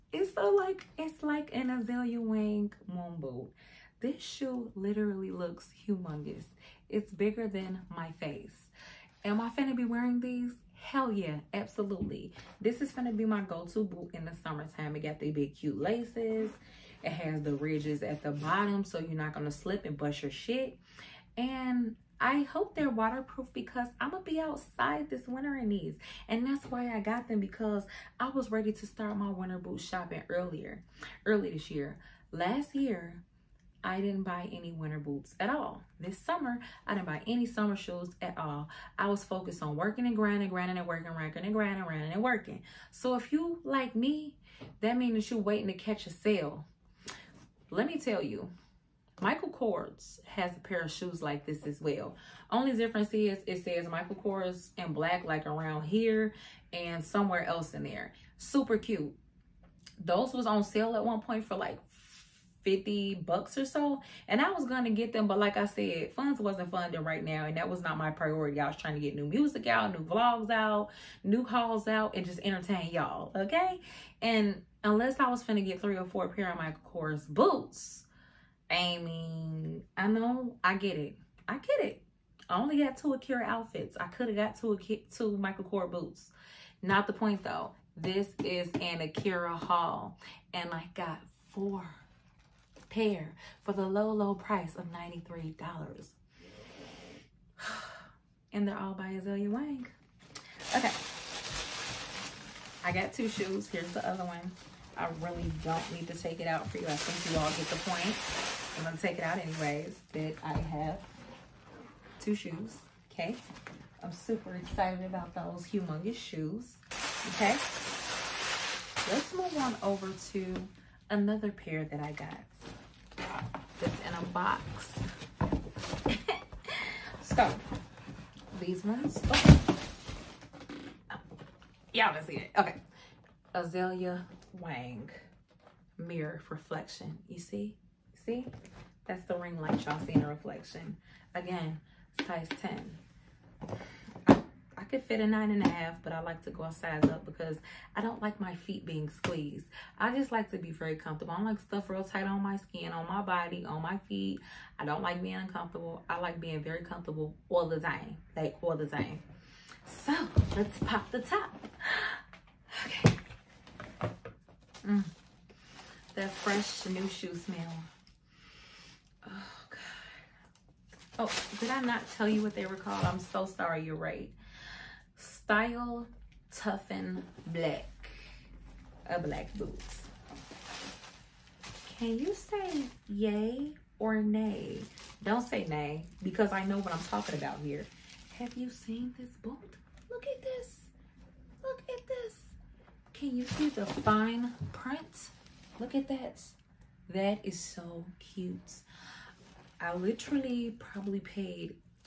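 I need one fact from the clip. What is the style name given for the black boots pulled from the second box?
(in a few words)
Toughen Black.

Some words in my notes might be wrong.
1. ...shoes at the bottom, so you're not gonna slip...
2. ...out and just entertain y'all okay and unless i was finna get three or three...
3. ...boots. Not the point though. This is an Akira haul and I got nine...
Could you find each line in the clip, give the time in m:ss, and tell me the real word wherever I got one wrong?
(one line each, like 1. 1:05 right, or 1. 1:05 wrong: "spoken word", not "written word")
1. 0:17 wrong: "ridges", not "shoes"
2. 1:11 wrong: "four", not "three"
3. 1:25 wrong: "four", not "nine".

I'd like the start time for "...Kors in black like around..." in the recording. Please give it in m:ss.
0:54.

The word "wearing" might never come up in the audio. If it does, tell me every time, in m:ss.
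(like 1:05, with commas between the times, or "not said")
0:09.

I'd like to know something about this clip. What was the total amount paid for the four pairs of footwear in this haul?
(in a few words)
$93.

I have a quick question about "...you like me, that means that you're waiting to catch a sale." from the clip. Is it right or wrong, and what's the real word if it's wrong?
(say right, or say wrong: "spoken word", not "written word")
right.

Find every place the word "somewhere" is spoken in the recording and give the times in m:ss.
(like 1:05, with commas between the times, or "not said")
0:57.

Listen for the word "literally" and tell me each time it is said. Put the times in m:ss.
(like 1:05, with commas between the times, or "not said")
0:04, 3:19.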